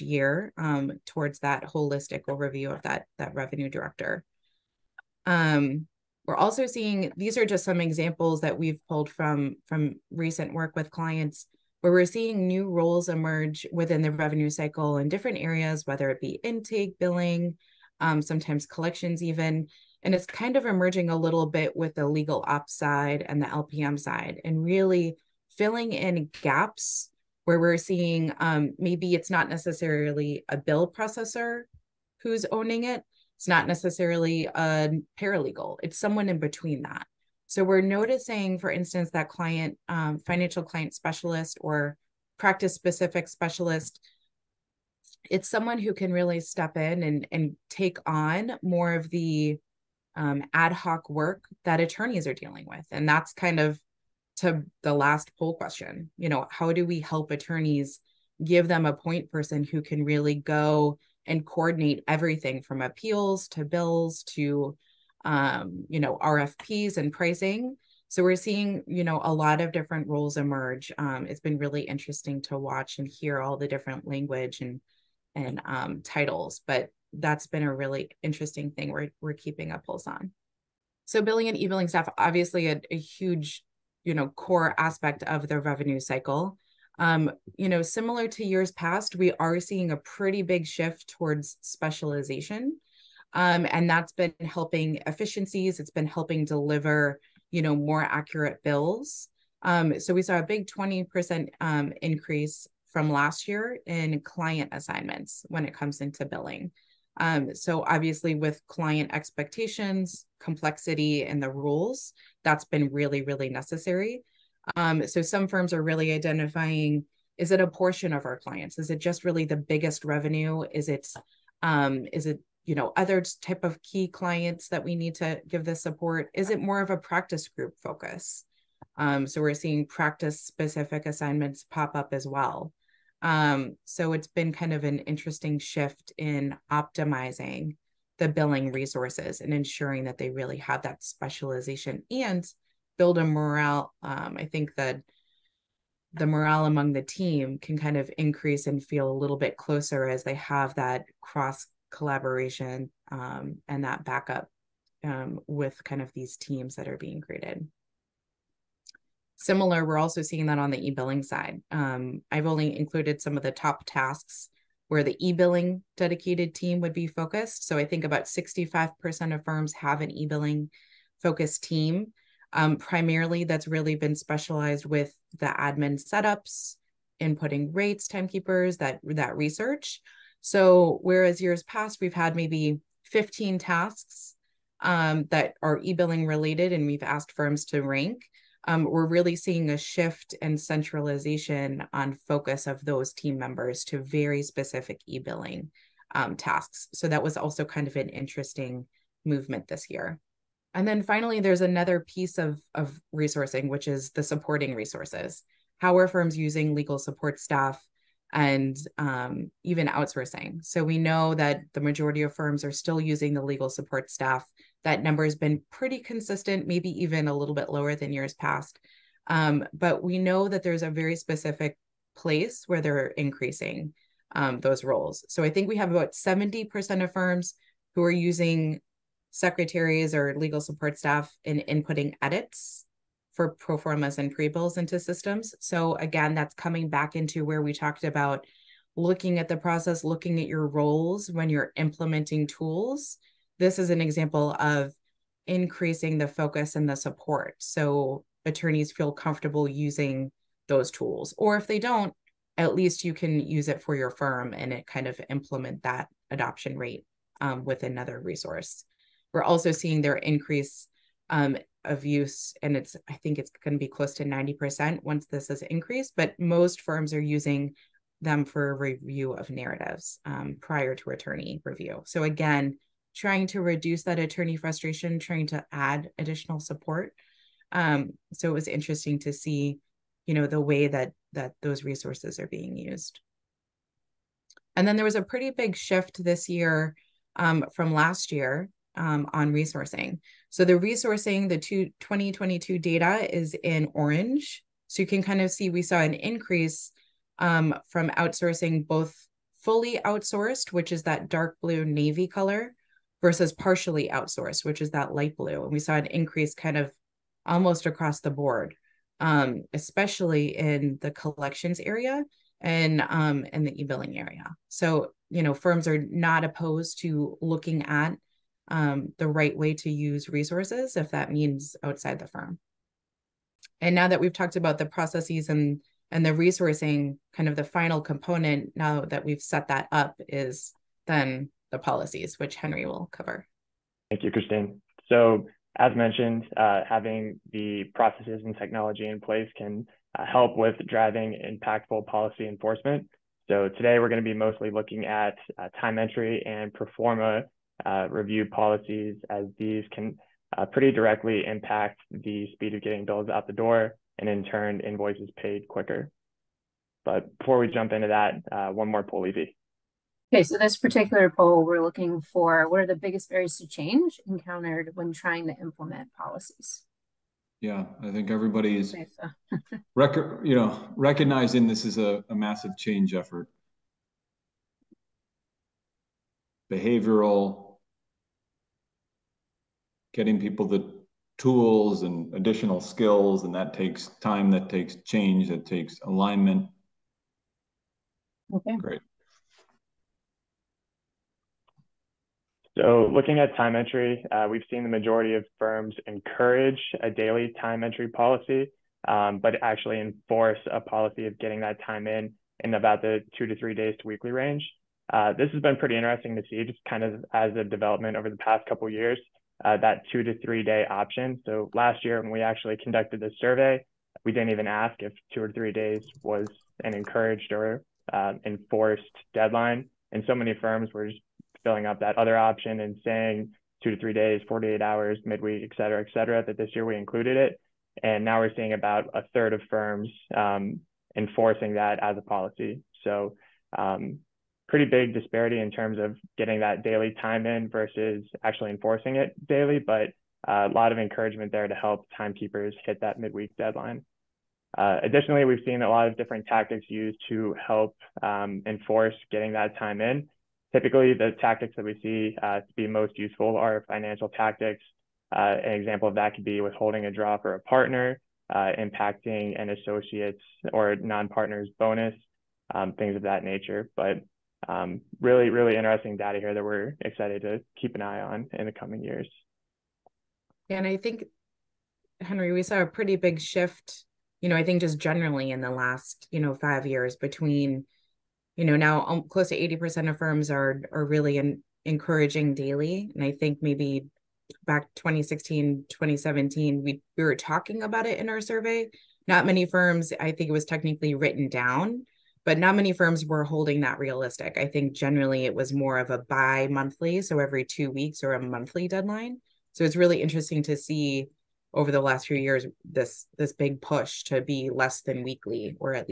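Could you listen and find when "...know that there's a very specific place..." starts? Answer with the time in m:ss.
3:40.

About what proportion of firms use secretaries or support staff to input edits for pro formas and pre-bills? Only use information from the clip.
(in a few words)
70%.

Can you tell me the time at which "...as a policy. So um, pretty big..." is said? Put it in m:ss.
7:12.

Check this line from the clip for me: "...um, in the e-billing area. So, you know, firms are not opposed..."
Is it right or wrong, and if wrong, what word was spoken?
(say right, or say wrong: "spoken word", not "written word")
right.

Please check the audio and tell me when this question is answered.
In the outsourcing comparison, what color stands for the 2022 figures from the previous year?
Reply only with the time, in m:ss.
4:53.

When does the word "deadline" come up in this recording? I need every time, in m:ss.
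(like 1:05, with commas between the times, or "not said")
6:59, 7:23, 8:18.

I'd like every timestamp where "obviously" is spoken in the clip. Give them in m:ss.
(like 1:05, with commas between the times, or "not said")
1:22, 1:47.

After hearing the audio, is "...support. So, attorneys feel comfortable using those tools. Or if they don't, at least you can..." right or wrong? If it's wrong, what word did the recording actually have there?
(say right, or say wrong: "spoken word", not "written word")
right.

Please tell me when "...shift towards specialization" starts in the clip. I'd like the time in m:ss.
1:30.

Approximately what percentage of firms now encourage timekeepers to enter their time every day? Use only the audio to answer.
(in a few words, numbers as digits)
80%.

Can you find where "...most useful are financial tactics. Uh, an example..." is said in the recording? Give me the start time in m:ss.
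7:32.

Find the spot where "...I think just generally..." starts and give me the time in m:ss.
7:54.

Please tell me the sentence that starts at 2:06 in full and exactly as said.
Is it more of a practice group focus?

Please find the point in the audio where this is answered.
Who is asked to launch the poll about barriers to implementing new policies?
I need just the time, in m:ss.
5:59.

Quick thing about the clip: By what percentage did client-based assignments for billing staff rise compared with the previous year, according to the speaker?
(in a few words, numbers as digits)
20%.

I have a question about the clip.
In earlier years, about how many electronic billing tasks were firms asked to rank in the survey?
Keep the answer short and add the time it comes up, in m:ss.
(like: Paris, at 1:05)
15, at 3:03.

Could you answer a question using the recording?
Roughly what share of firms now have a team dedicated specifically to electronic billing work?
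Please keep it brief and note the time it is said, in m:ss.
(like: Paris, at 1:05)
65%, at 2:48.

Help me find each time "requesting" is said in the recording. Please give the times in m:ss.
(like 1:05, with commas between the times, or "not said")
not said.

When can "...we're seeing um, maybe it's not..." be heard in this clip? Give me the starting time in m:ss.
0:27.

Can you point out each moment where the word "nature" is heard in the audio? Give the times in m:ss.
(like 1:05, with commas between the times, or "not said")
7:43.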